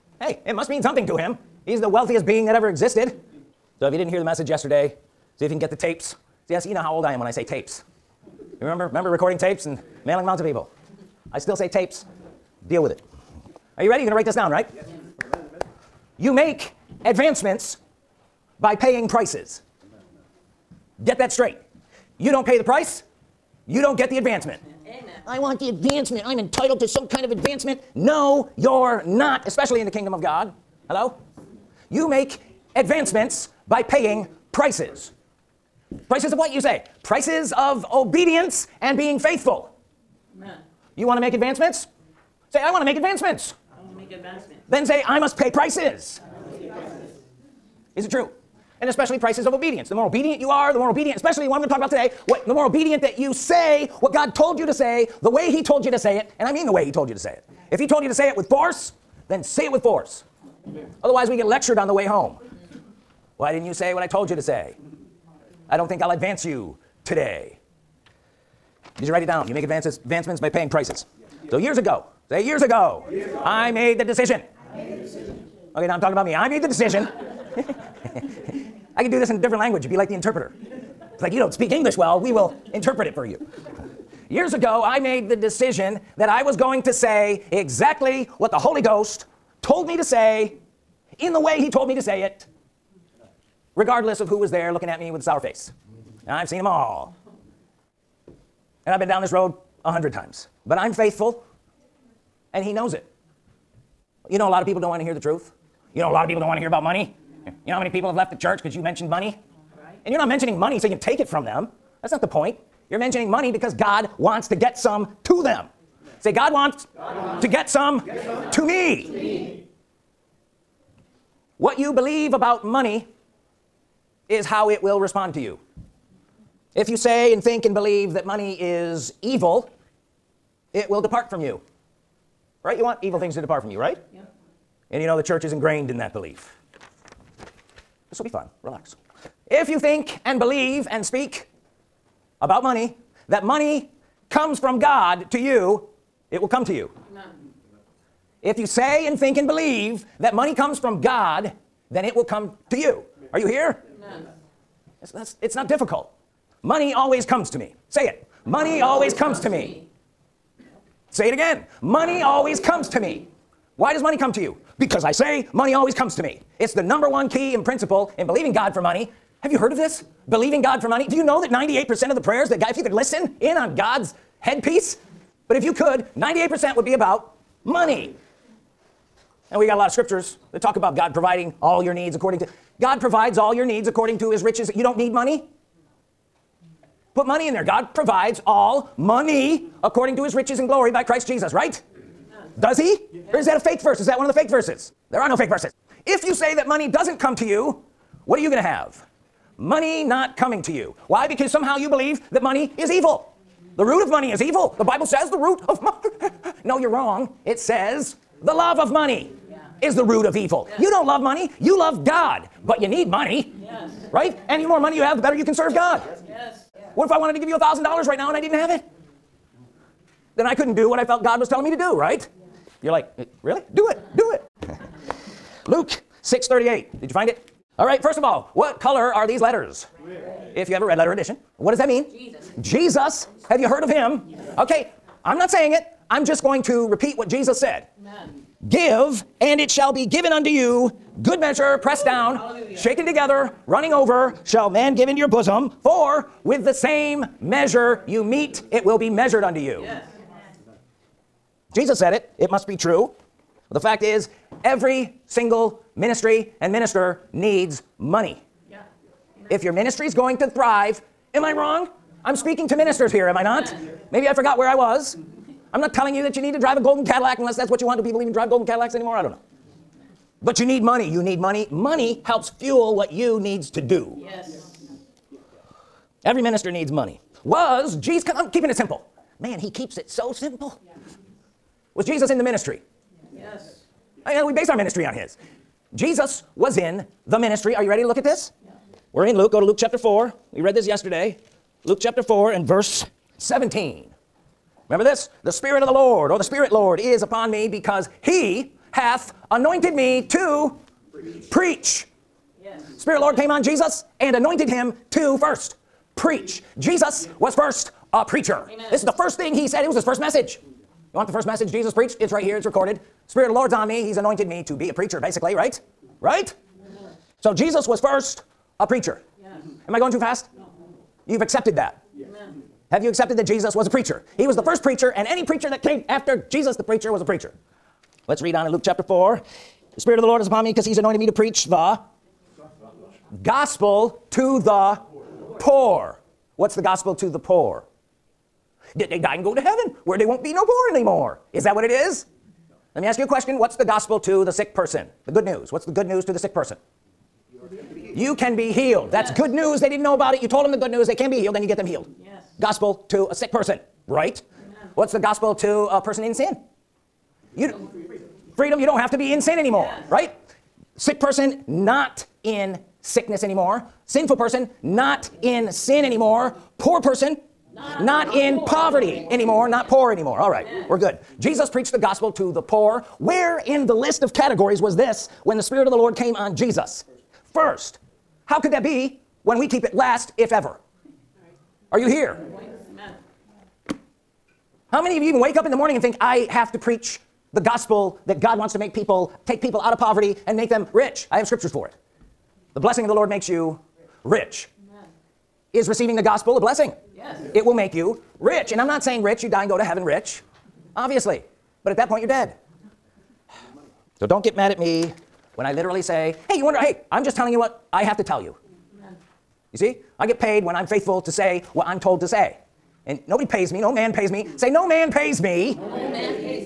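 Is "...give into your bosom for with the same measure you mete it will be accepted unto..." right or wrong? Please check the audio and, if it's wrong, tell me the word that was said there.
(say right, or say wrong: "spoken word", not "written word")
wrong: "measured", not "accepted".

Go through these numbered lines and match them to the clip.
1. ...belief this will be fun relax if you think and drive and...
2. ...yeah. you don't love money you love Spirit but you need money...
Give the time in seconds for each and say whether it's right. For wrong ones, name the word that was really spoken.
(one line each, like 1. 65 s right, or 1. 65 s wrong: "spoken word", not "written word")
1. 136 s wrong: "believe", not "drive"
2. 210 s wrong: "God", not "Spirit".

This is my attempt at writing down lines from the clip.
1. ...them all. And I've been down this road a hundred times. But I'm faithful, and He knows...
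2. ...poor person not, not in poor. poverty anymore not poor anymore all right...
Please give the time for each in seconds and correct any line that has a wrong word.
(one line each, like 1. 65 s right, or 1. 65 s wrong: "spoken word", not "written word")
1. 96 s right
2. 366 s right.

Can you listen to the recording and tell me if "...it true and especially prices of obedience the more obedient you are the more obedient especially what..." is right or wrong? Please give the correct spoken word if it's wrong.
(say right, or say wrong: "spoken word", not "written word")
right.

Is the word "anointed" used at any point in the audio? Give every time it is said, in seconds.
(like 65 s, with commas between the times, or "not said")
299 s, 304 s, 314 s, 330 s.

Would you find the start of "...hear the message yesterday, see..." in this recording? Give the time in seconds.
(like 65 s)
4 s.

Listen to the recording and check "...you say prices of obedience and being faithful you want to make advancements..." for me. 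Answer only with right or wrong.
right.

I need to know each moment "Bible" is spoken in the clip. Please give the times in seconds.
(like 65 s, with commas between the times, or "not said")
204 s.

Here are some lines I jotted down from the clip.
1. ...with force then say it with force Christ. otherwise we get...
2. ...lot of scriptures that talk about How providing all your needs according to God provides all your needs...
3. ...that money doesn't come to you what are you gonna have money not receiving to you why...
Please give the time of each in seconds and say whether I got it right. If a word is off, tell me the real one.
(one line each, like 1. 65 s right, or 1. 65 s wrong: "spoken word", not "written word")
1. 58 s wrong: "Amen", not "Christ"
2. 179 s wrong: "God", not "How"
3. 196 s wrong: "coming", not "receiving".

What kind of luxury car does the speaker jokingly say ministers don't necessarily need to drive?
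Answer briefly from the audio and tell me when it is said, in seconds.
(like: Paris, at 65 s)
Golden Cadillac, at 266 s.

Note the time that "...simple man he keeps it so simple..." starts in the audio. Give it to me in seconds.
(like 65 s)
278 s.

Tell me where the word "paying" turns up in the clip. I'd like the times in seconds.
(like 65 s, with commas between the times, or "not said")
18 s, 33 s, 70 s.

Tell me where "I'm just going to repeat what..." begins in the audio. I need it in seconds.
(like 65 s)
236 s.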